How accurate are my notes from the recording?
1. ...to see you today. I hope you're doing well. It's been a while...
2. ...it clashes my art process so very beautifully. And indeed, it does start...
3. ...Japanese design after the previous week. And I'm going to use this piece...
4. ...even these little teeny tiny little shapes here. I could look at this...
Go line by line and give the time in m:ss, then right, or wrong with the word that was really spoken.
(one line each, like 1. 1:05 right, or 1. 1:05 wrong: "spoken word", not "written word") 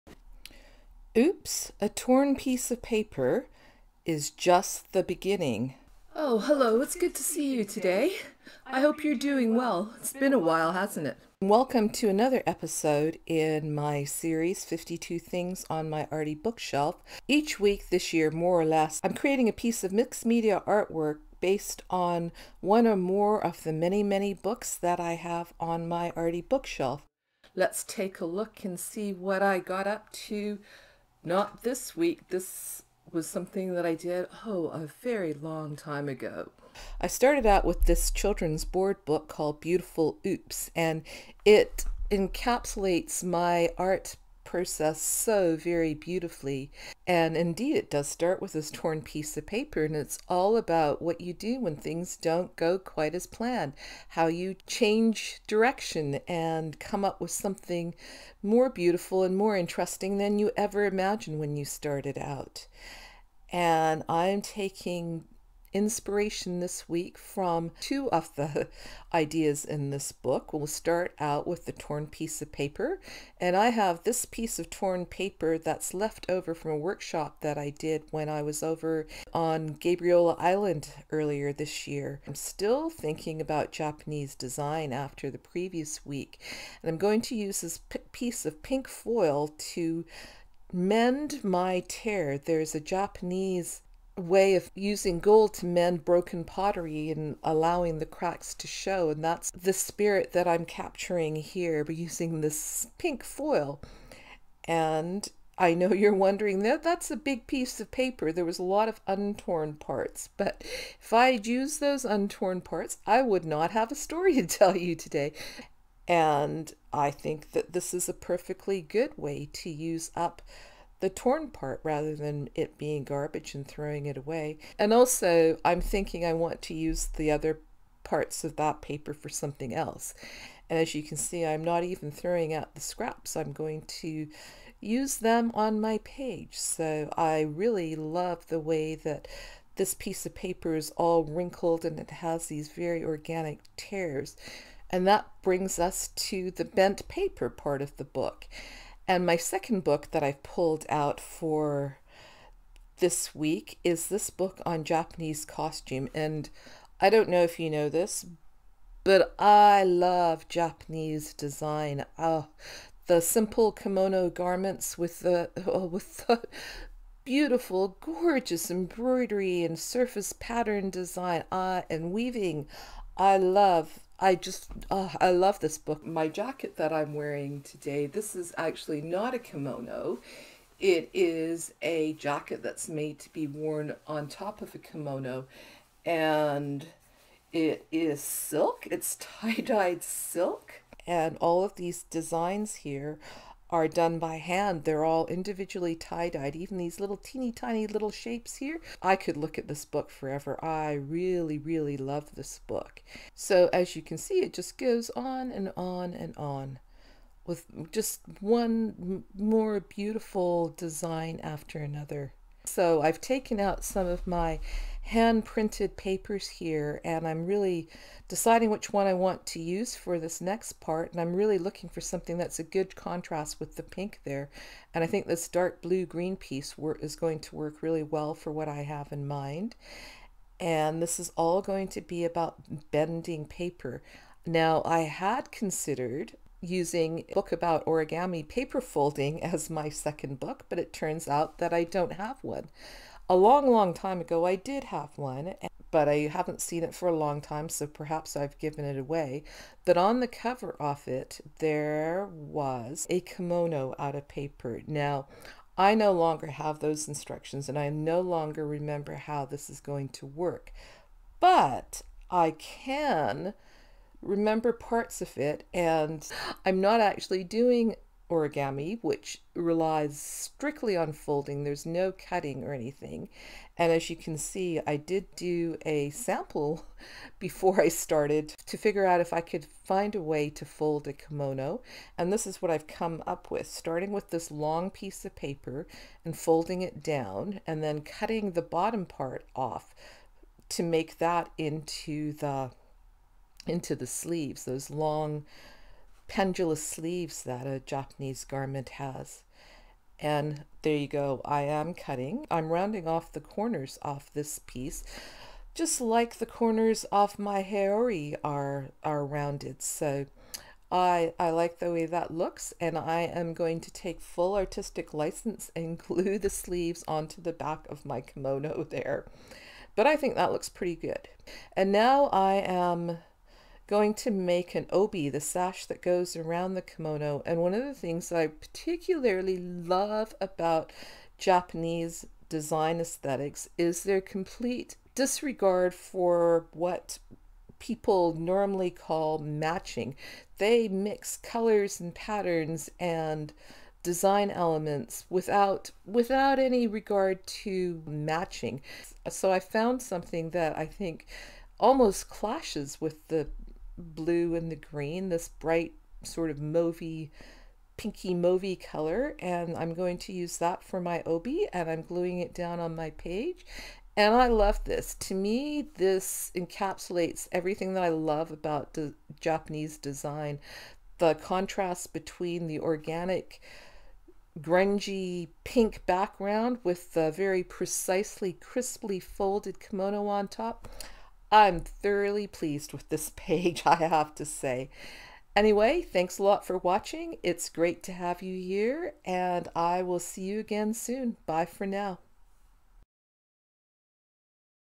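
1. 0:07 right
2. 0:41 wrong: "encapsulates", not "clashes"
3. 1:23 right
4. 3:16 right.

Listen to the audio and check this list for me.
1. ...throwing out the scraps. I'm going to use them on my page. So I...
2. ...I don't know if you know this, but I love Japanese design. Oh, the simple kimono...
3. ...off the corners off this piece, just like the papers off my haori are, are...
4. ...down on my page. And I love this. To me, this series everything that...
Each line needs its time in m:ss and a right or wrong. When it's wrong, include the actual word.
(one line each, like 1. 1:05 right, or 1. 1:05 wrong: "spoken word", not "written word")
1. 2:12 right
2. 2:37 right
3. 5:03 wrong: "corners", not "papers"
4. 6:02 wrong: "encapsulates", not "series".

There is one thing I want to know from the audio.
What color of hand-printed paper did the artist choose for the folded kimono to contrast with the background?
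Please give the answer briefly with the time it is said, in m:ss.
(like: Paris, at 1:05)
dark blue green, at 3:45.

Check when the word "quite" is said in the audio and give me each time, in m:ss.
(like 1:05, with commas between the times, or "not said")
0:52.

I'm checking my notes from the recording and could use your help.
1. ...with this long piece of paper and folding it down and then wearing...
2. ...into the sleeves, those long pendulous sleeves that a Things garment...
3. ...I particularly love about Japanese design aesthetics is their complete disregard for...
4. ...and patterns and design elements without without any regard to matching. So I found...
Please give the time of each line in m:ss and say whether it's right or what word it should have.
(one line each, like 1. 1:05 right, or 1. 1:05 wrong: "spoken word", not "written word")
1. 4:44 wrong: "cutting", not "wearing"
2. 4:53 wrong: "Japanese", not "Things"
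3. 5:28 right
4. 5:41 right.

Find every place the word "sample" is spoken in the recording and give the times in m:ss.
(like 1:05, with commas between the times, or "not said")
4:36.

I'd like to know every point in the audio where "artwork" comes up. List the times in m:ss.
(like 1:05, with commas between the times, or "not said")
0:20.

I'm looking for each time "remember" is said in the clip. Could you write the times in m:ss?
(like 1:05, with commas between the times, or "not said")
4:18, 4:24.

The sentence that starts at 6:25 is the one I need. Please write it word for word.
Anyway, thanks a lot for watching.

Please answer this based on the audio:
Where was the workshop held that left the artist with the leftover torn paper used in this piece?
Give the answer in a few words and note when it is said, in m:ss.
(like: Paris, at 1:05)
Gabriola Island, at 1:19.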